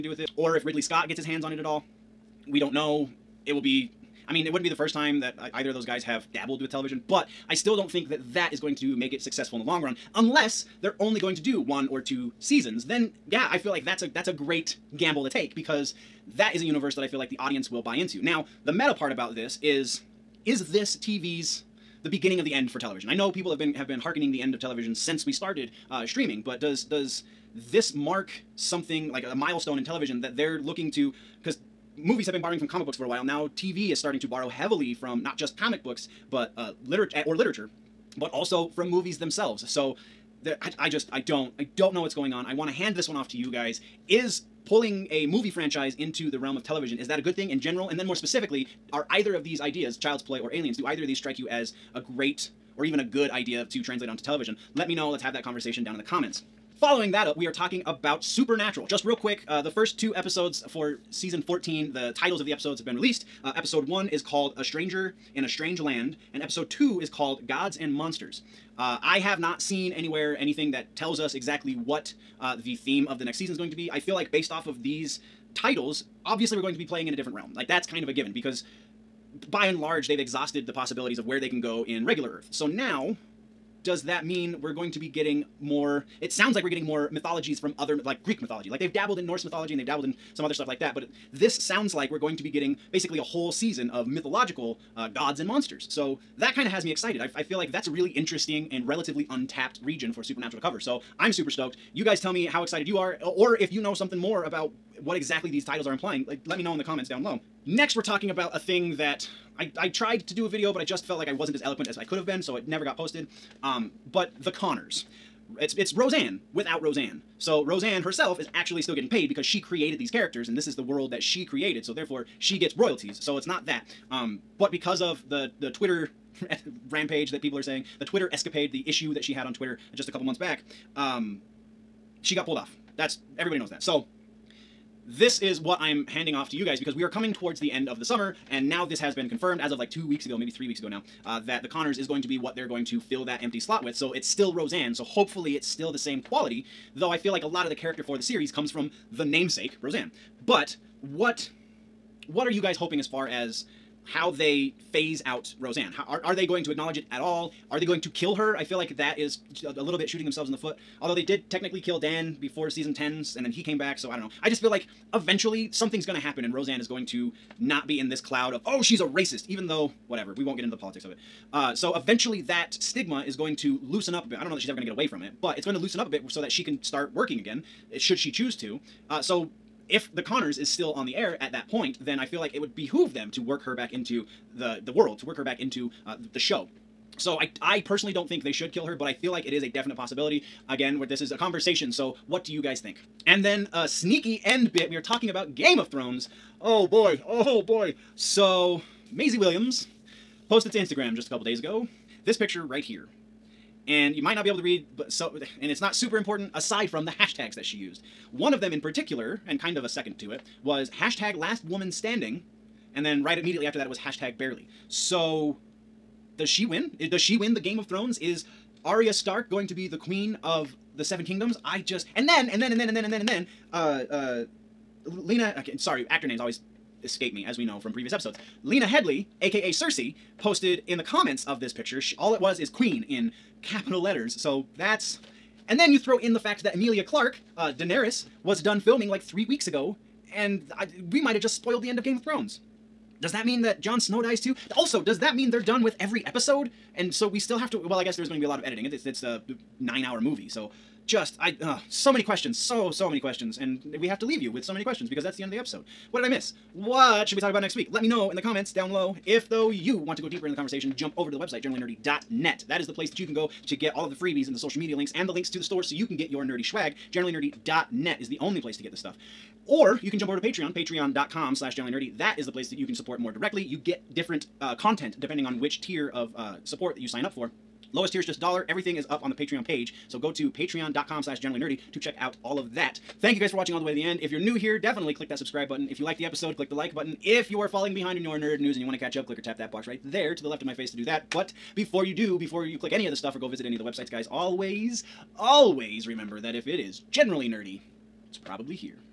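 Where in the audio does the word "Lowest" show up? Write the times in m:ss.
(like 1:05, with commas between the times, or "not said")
4:37.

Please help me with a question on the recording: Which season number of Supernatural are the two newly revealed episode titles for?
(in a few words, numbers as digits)
14.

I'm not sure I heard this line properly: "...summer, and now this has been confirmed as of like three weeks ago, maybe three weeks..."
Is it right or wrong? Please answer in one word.
wrong.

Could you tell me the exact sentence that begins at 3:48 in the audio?
Lena Headley, aka Cersei, posted in the comments of this picture, she, all it was is Queen in capital letters.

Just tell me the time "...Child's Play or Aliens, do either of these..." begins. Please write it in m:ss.
0:49.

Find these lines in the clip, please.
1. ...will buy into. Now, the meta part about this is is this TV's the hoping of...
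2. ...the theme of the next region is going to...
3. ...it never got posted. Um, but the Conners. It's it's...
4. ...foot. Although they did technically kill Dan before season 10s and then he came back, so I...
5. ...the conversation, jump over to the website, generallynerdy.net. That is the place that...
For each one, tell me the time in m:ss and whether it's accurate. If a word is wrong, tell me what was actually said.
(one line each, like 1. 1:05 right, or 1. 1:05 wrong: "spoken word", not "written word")
1. 0:17 wrong: "beginning", not "hoping"
2. 1:12 wrong: "season", not "region"
3. 1:52 right
4. 2:40 right
5. 4:20 right.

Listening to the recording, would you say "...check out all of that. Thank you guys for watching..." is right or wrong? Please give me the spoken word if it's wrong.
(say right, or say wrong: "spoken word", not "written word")
right.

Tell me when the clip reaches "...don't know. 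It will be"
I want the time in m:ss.
0:02.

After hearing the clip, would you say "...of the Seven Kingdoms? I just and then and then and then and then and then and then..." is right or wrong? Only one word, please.
right.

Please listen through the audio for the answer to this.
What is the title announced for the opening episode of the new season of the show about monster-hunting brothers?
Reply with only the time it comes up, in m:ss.
1:04.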